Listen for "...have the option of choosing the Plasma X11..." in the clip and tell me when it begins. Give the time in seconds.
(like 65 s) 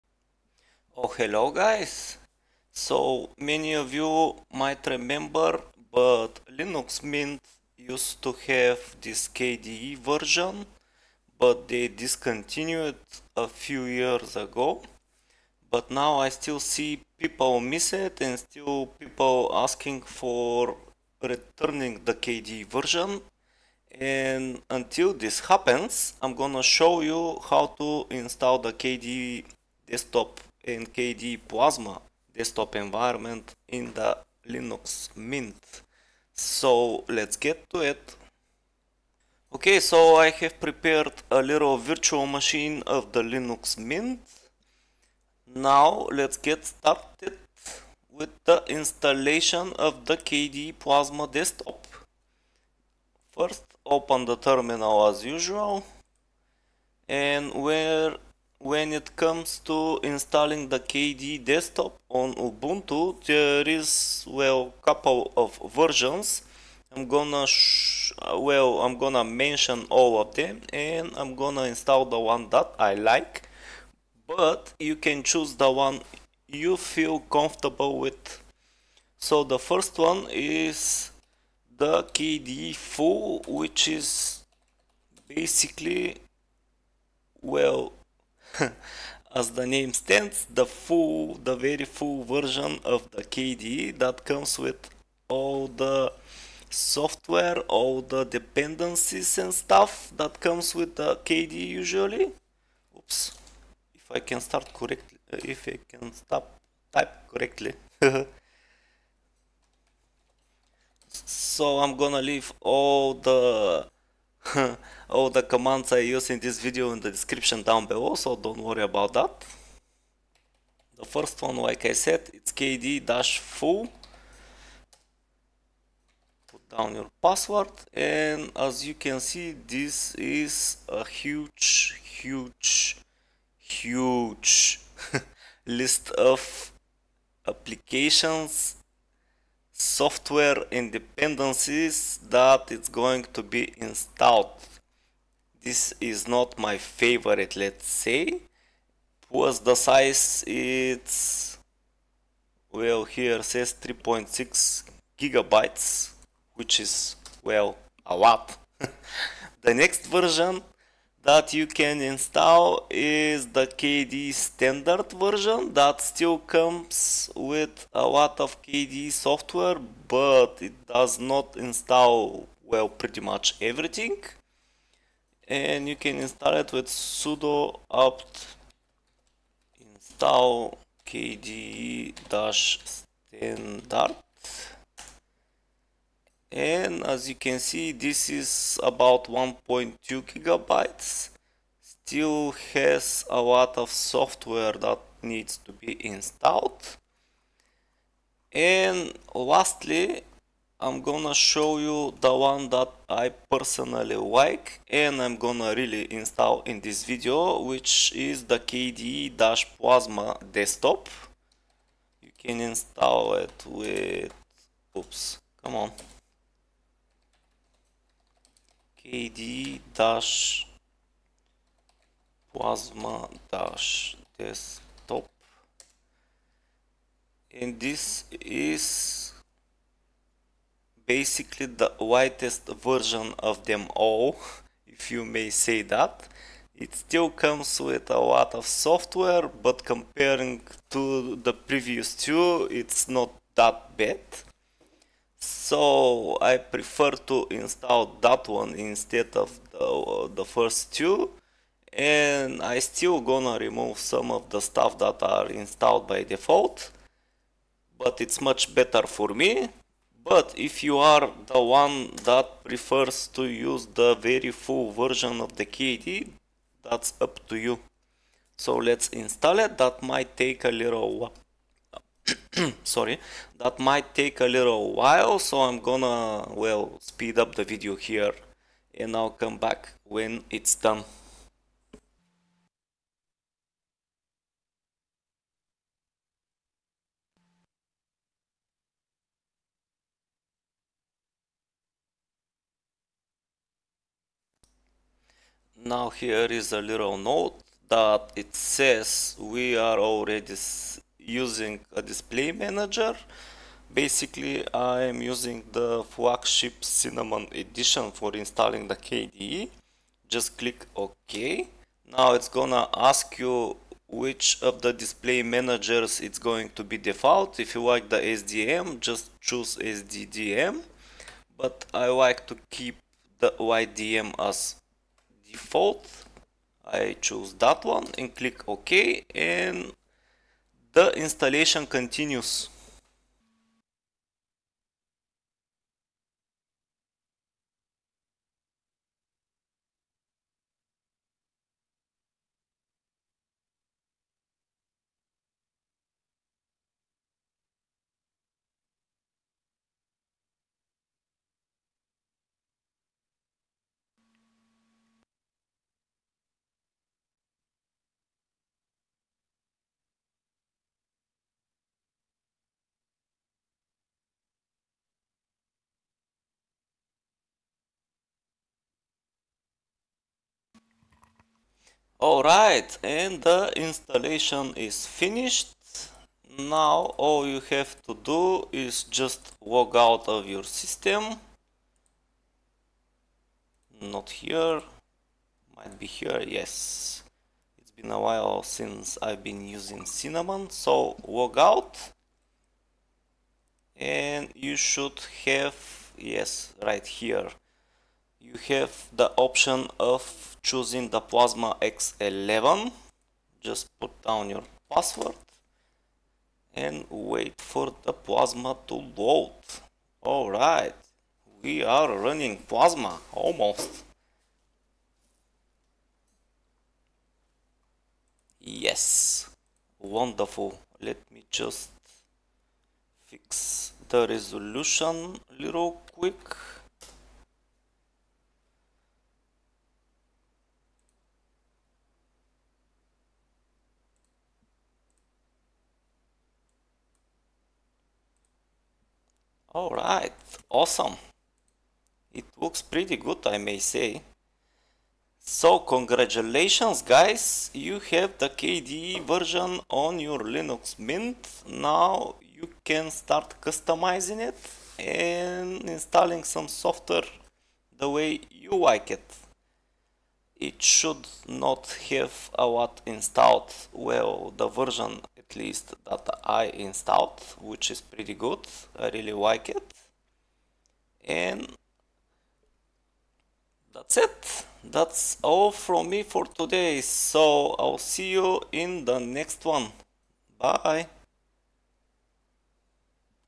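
398 s.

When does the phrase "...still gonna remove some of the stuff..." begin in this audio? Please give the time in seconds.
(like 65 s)
252 s.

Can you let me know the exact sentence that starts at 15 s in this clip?
But now I still see people miss it and still people asking for returning the KDE version.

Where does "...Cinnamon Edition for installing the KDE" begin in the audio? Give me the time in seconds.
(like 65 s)
306 s.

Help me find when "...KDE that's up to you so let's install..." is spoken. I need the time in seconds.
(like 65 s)
265 s.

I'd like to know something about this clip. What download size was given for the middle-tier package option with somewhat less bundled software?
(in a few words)
1.2 gigabytes.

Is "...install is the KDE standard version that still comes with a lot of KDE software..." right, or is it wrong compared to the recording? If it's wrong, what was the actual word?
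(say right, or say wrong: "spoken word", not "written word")
right.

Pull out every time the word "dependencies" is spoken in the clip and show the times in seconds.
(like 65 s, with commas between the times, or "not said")
98 s, 140 s.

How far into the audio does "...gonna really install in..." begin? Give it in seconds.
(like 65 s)
205 s.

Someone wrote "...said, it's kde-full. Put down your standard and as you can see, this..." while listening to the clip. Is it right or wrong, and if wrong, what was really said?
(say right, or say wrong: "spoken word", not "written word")
wrong: "password", not "standard".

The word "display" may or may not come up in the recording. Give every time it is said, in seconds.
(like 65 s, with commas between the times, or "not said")
302 s, 314 s.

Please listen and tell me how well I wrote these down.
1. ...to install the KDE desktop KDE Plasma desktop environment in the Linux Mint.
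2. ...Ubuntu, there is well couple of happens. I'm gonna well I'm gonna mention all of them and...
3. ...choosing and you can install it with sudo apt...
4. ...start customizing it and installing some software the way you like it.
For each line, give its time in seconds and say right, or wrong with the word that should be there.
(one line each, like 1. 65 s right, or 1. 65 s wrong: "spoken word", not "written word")
1. 27 s right
2. 62 s wrong: "versions", not "happens"
3. 173 s wrong: "everything", not "choosing"
4. 453 s right.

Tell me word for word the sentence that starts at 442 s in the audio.
It looks pretty good, I may say.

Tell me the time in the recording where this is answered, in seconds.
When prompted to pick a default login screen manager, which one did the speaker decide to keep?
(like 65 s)
323 s.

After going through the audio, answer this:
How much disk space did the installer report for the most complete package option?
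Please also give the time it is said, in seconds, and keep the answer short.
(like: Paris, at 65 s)
3.6 gigabytes, at 153 s.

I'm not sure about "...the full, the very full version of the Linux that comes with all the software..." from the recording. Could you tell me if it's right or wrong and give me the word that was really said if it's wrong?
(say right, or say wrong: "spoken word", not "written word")
wrong: "KDE", not "Linux".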